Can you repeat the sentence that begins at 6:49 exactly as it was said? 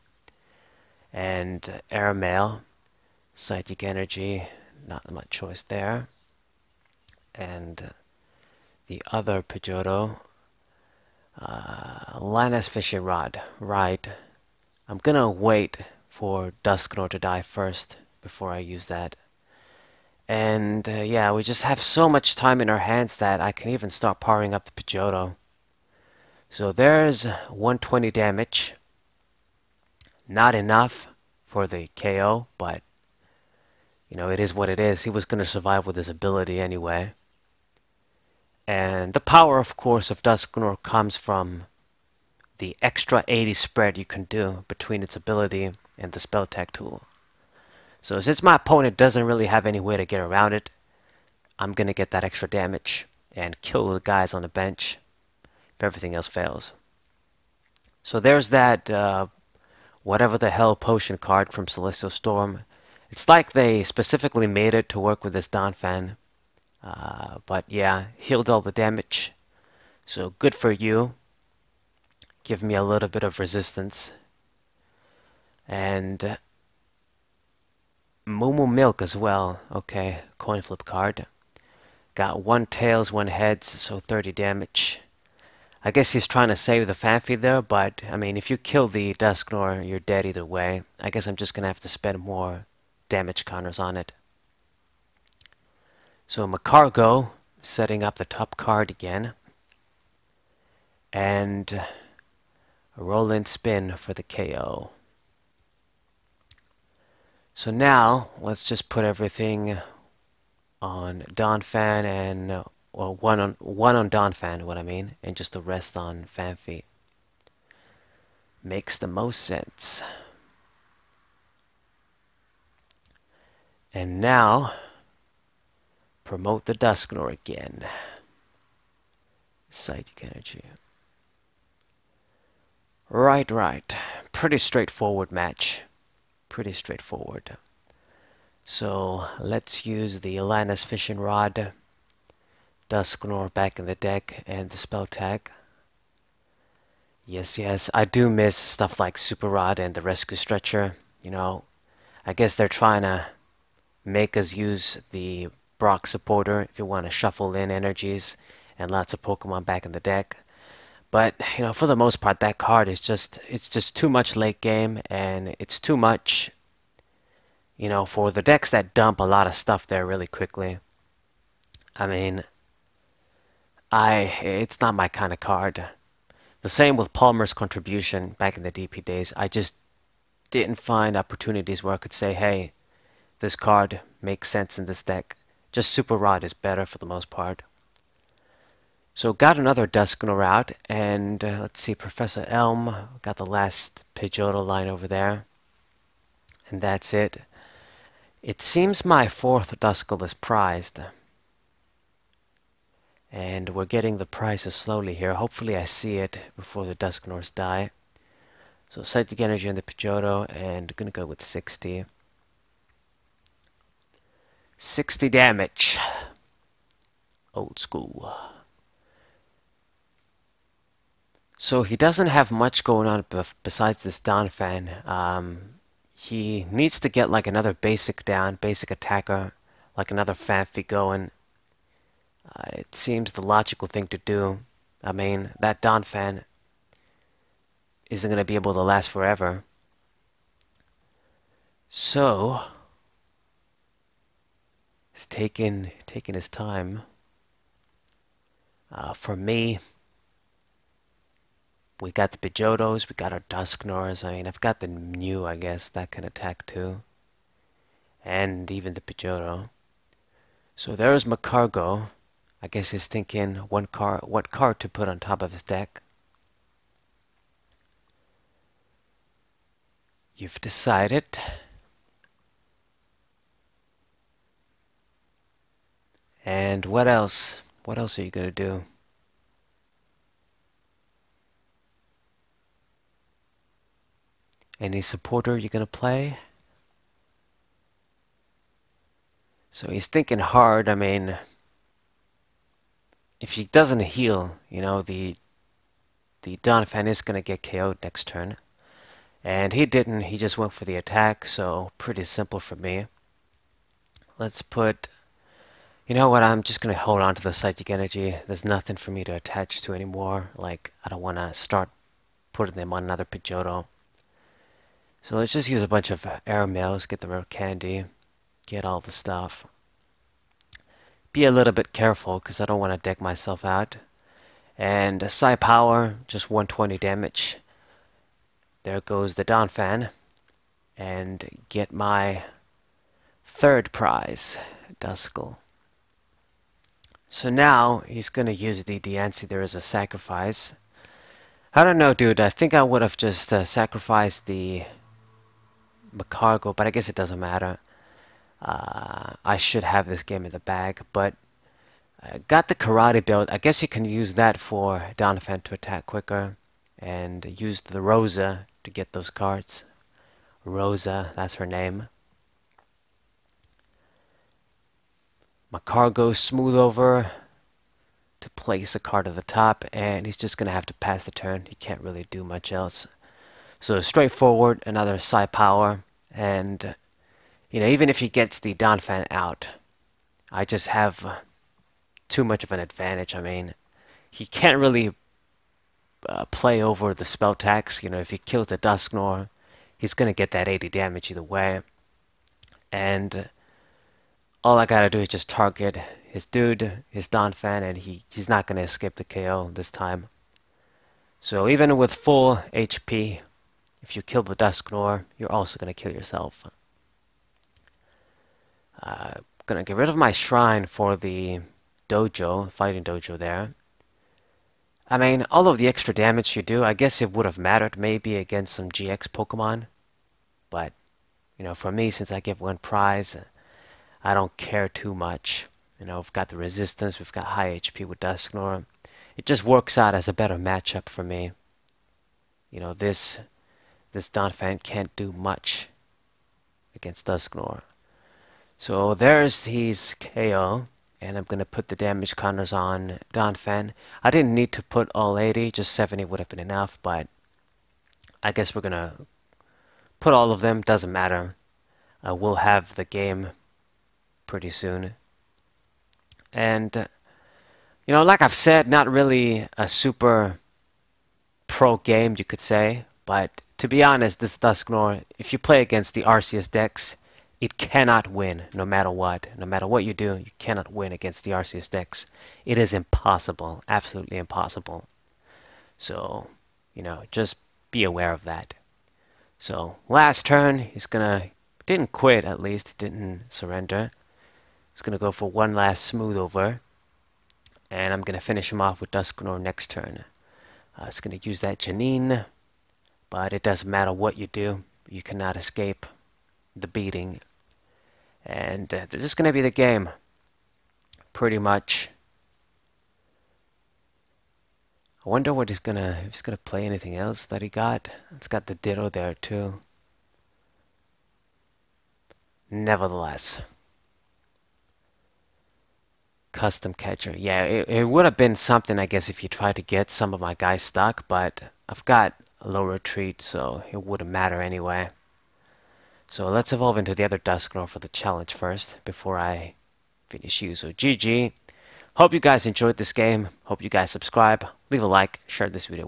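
Uh, gonna get rid of my shrine for the dojo, fighting dojo there.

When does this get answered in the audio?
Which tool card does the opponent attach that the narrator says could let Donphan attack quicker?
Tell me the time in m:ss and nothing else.
5:52.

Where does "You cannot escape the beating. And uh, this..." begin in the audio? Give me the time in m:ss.
8:15.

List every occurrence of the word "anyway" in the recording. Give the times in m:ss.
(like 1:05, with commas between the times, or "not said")
0:36, 8:44.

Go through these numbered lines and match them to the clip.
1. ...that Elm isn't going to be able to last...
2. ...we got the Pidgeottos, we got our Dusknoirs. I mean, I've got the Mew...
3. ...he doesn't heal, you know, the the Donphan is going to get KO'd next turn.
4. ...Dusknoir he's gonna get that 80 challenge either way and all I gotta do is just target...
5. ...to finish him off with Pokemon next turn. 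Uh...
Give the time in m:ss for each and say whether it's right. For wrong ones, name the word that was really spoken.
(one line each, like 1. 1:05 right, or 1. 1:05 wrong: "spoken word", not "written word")
1. 3:55 wrong: "Donphan", not "Elm"
2. 4:12 right
3. 4:53 right
4. 6:28 wrong: "damage", not "challenge"
5. 8:08 wrong: "Dusknoir", not "Pokemon".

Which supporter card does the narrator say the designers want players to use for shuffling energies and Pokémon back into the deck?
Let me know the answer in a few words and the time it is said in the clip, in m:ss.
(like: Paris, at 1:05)
Brock, at 2:35.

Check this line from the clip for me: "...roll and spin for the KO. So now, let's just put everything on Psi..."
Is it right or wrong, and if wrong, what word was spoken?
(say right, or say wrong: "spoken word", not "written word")
wrong: "Donphan", not "Psi".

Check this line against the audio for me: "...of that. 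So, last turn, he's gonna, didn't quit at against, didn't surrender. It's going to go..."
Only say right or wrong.
wrong.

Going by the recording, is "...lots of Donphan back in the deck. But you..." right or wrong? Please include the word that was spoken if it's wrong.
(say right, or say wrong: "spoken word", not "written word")
wrong: "Pokemon", not "Donphan".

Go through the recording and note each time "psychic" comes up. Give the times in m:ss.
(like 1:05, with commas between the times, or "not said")
0:03, 2:09, 3:29, 5:07.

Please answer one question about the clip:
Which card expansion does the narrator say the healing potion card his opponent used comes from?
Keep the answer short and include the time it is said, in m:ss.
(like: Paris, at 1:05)
Celestial Storm, at 1:01.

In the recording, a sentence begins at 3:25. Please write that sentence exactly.
Hopefully I see it before the Dusknoirs die.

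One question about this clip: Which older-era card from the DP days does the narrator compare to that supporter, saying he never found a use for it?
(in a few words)
Palmer's Contribution.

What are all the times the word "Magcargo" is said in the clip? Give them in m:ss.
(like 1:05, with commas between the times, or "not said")
1:36, 4:21, 5:46.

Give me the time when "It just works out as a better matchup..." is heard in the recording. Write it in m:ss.
7:09.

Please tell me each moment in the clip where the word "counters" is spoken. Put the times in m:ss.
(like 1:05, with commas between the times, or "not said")
1:33, 7:22.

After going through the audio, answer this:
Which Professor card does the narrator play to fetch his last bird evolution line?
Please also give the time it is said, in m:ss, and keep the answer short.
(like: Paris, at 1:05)
Professor Elm, at 3:11.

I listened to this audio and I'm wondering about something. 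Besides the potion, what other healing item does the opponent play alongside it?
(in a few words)
Moomoo Milk.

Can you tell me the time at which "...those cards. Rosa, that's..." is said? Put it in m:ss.
5:59.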